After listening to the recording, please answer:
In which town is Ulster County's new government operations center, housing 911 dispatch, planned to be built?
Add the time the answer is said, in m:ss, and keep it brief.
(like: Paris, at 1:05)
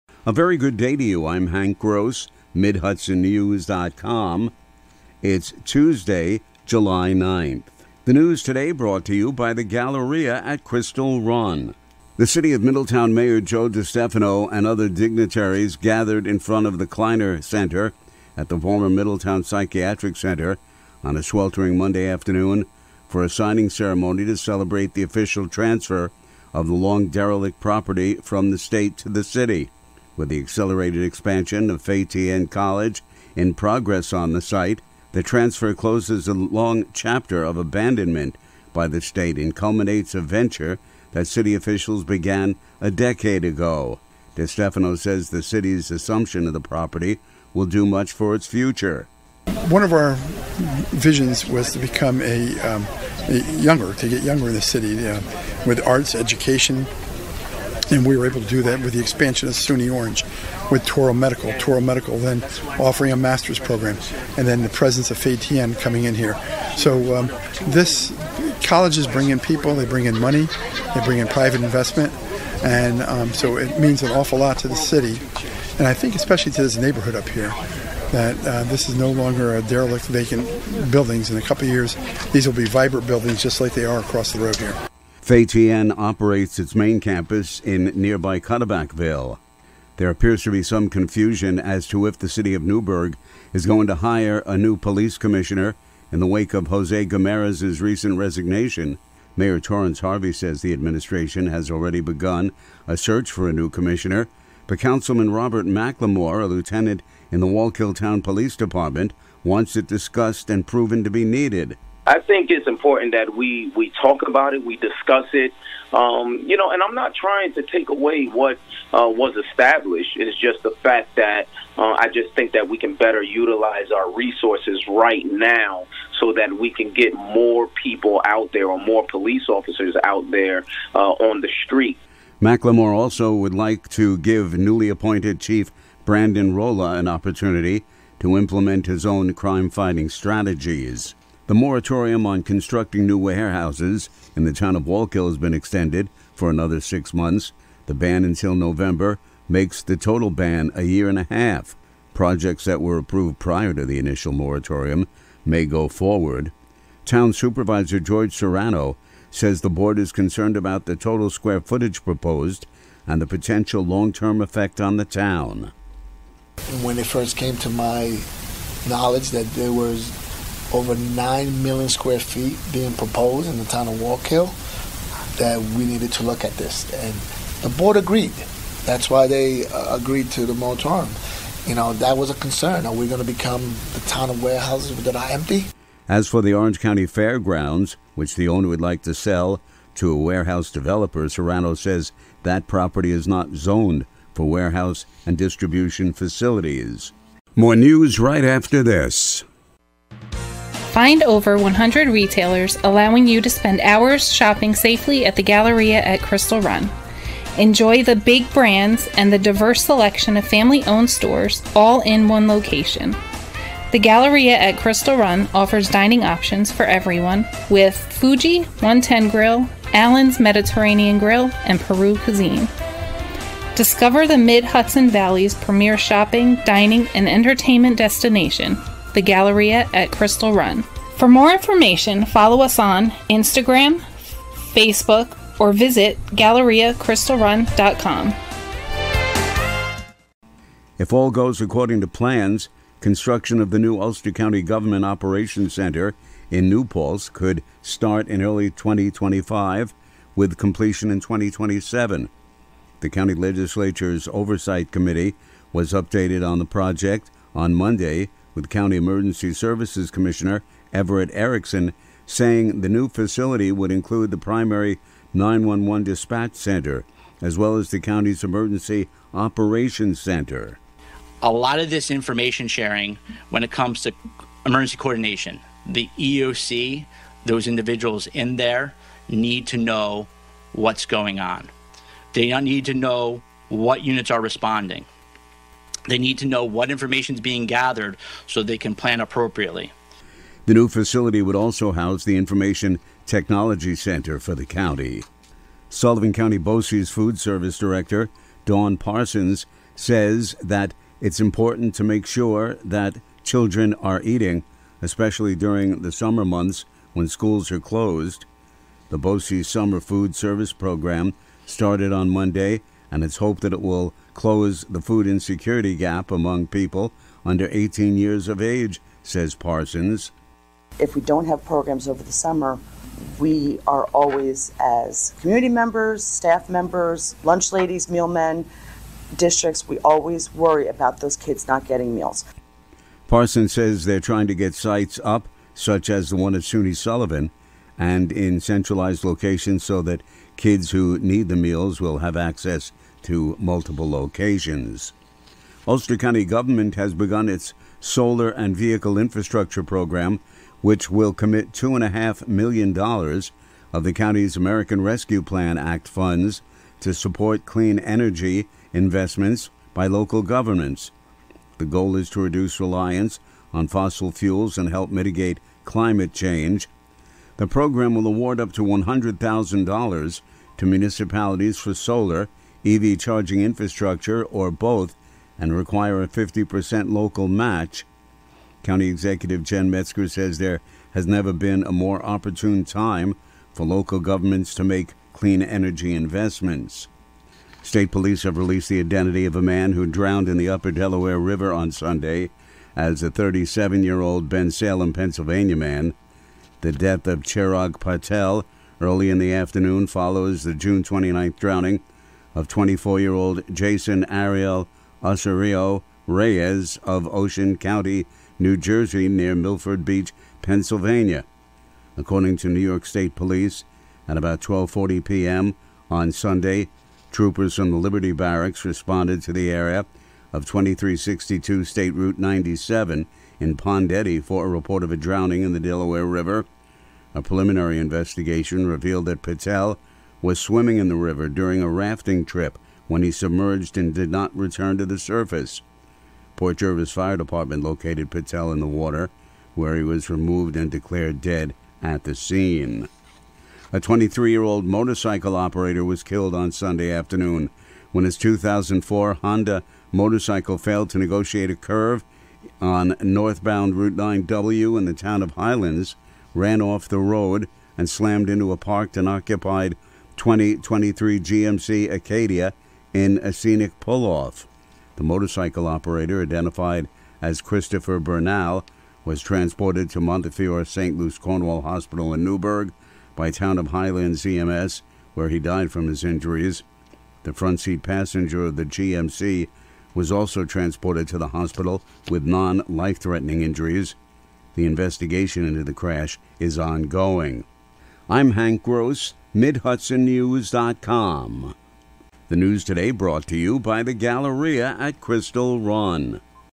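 New Paltz, at 4:06.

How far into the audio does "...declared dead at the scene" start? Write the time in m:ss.
7:20.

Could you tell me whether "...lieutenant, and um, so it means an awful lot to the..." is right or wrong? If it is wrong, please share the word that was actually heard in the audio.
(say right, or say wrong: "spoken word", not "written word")
wrong: "investment", not "lieutenant".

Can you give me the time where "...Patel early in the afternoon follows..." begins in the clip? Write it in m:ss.
6:37.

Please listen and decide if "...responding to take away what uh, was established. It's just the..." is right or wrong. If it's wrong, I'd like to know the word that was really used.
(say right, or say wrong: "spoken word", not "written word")
wrong: "trying", not "responding".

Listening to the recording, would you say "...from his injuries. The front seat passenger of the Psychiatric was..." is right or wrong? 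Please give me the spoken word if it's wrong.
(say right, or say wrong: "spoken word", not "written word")
wrong: "GMC", not "Psychiatric".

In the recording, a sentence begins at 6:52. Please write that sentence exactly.
According to New York State Police, at about 12:40 p.m.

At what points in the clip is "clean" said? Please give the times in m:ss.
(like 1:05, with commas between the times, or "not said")
5:57, 6:25.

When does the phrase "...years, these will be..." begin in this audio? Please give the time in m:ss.
1:21.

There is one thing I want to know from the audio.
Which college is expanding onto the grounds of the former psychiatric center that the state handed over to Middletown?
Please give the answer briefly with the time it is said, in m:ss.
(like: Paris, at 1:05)
Fei Tian College, at 0:31.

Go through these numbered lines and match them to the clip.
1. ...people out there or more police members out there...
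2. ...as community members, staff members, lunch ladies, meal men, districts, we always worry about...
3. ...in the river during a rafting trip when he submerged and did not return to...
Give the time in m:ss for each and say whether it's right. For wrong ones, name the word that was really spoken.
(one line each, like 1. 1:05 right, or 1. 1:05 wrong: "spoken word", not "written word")
1. 2:07 wrong: "officers", not "members"
2. 5:24 right
3. 7:10 right.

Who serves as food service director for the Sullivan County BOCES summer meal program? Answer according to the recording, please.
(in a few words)
Dawn Parsons.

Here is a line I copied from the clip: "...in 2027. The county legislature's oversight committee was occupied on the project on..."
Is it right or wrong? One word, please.
wrong.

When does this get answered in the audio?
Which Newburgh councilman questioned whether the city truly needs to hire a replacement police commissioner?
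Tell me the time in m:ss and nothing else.
1:45.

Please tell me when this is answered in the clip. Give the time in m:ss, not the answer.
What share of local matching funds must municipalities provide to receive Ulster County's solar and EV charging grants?
6:16.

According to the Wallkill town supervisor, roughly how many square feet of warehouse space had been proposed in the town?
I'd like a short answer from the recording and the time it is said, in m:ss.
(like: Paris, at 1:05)
over 9 million, at 2:50.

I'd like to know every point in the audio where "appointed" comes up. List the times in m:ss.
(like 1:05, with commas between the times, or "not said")
2:14.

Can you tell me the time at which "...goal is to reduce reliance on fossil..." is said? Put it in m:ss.
6:01.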